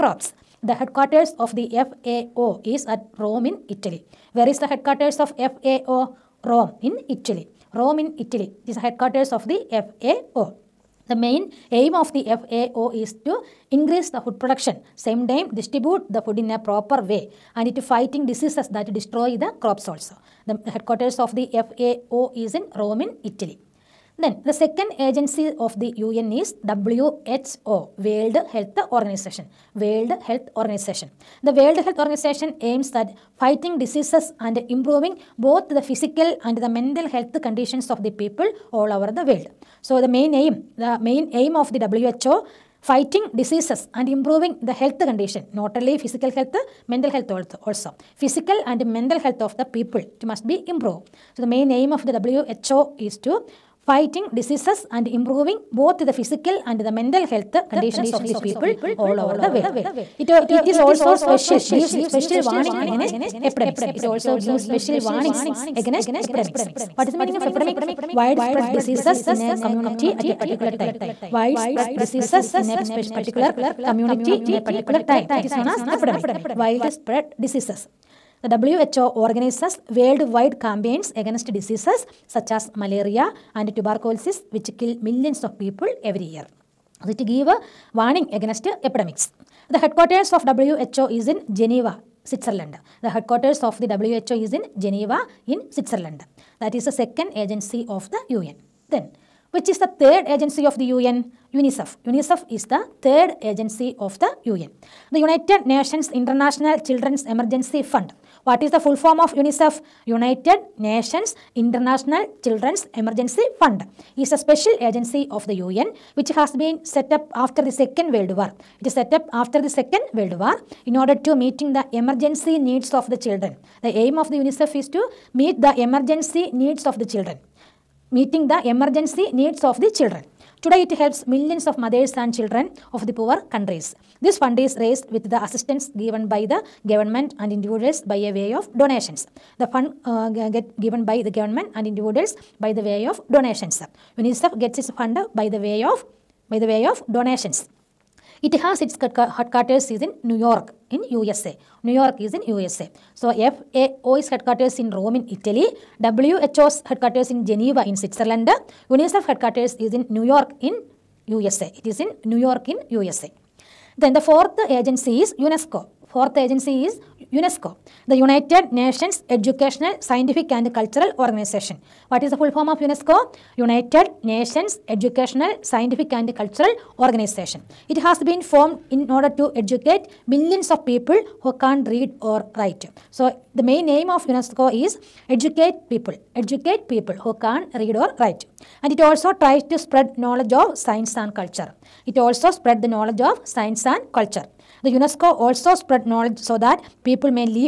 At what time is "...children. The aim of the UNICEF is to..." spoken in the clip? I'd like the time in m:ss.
2:03.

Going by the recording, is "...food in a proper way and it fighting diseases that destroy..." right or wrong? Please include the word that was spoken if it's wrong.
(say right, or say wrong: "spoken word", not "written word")
right.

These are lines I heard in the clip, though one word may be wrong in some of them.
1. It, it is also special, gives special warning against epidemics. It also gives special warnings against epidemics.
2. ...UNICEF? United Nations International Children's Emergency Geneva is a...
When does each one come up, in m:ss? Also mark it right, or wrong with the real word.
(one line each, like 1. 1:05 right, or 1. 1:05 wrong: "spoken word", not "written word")
1. 1:00 right
2. 1:49 wrong: "Fund", not "Geneva".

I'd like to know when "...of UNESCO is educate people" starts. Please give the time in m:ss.
3:04.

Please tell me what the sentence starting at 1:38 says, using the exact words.
Then, which is the third agency of the UN?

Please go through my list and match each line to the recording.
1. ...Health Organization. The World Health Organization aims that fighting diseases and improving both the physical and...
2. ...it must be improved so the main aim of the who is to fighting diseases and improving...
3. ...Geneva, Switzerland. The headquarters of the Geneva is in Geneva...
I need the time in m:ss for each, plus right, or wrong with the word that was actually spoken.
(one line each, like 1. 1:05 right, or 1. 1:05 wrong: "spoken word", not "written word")
1. 0:30 right
2. 0:50 right
3. 1:31 wrong: "WHO", not "Geneva".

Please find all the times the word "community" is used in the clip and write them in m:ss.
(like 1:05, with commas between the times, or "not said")
1:09, 1:13.